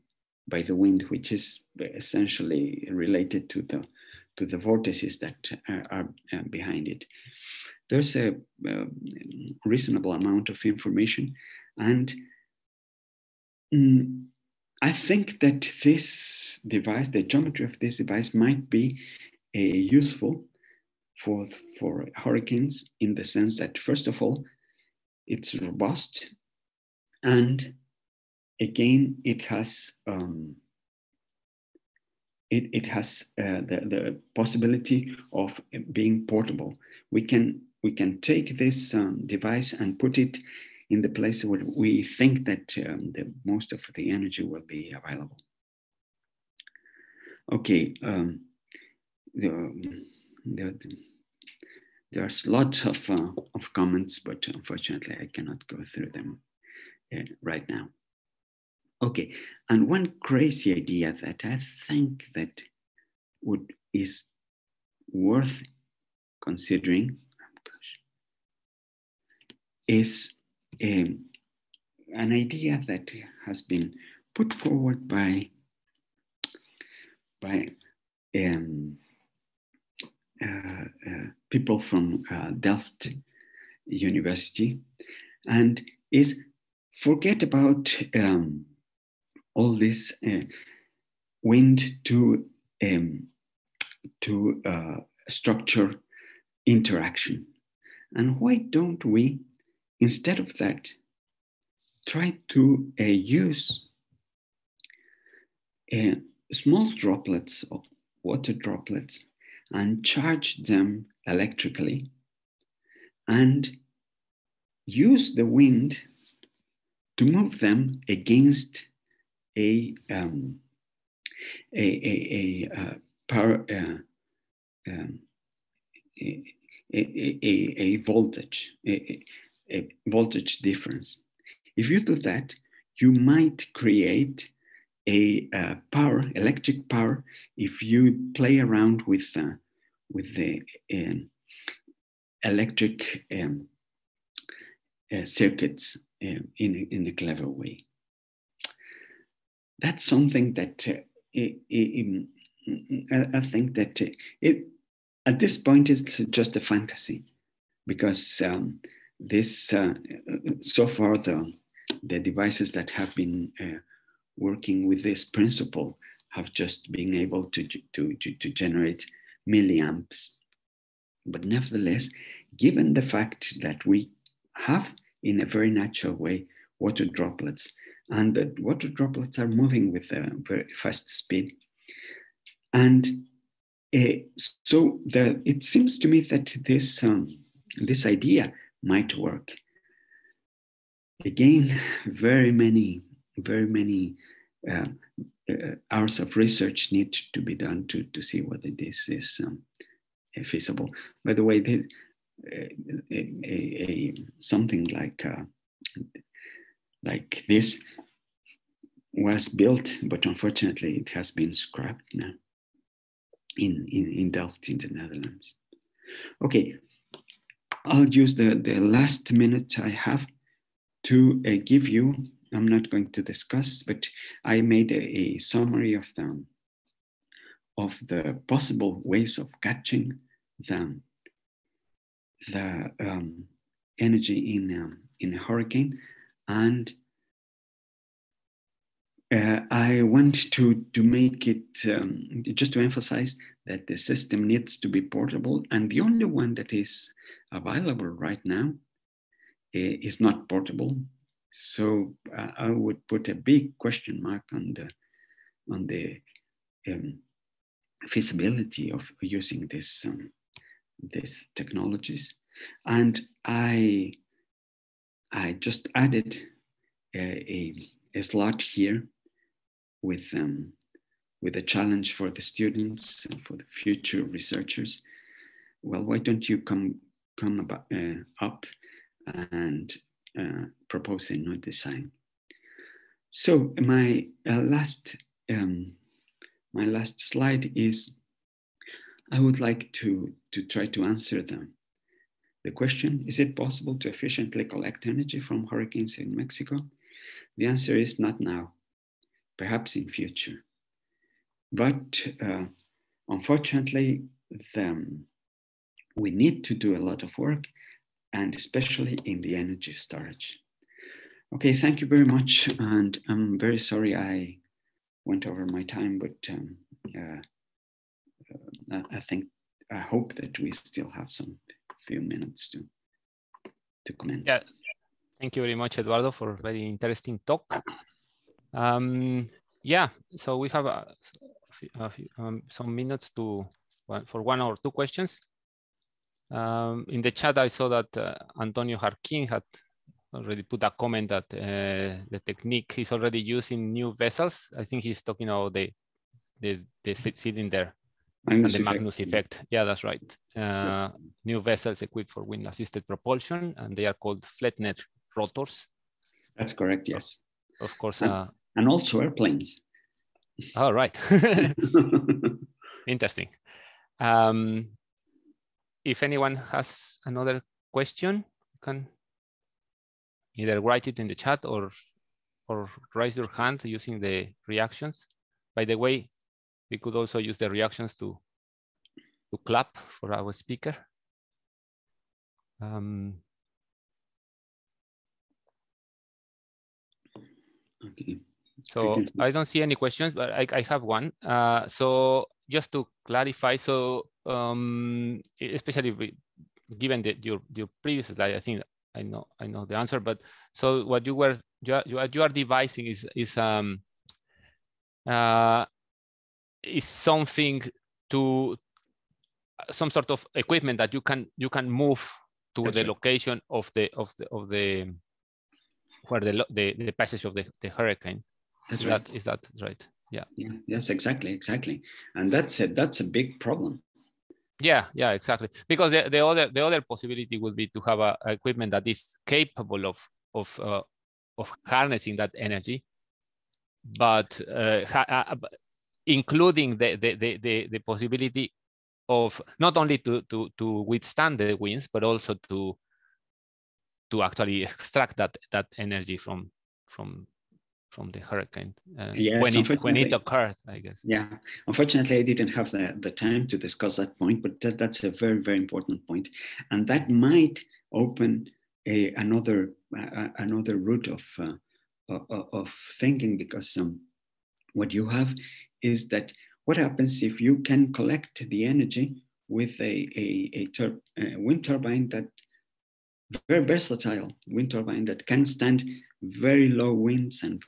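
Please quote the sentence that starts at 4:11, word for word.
So uh, I would put a big question mark on the on the um, feasibility of using this um, these technologies.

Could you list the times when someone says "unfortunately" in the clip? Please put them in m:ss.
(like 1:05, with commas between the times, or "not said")
0:54, 3:30, 5:03, 7:31.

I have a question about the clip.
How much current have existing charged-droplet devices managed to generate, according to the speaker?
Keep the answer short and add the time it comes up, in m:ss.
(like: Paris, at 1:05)
milliamps, at 2:49.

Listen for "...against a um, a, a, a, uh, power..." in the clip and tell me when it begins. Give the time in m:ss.
1:58.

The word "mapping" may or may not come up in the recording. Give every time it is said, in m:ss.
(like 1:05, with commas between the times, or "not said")
not said.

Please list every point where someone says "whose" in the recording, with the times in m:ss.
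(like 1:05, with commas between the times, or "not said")
not said.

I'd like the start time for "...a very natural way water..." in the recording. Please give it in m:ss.
2:55.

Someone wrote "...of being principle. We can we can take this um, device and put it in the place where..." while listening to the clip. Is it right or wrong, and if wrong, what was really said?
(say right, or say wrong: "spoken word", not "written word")
wrong: "portable", not "principle".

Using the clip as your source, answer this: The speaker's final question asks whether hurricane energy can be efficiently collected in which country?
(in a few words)
Mexico.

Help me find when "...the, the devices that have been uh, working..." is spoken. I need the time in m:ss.
2:41.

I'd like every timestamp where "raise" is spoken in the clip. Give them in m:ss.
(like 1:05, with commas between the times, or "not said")
6:13.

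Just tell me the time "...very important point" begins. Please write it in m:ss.
7:35.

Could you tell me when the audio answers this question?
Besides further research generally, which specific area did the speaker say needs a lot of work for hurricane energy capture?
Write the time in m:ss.
5:09.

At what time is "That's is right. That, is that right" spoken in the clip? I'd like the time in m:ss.
6:58.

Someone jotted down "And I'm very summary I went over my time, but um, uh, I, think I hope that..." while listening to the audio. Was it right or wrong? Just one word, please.
wrong.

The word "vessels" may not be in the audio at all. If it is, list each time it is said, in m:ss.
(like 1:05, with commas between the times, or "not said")
5:44, 5:51.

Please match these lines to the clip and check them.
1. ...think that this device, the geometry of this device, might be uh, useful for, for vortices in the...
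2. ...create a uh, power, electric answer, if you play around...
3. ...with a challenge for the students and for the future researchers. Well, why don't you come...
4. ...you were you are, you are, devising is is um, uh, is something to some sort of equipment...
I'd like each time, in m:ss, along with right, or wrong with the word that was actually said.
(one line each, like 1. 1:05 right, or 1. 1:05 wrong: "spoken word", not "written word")
1. 0:14 wrong: "hurricanes", not "vortices"
2. 2:13 wrong: "power", not "answer"
3. 4:31 right
4. 6:41 right.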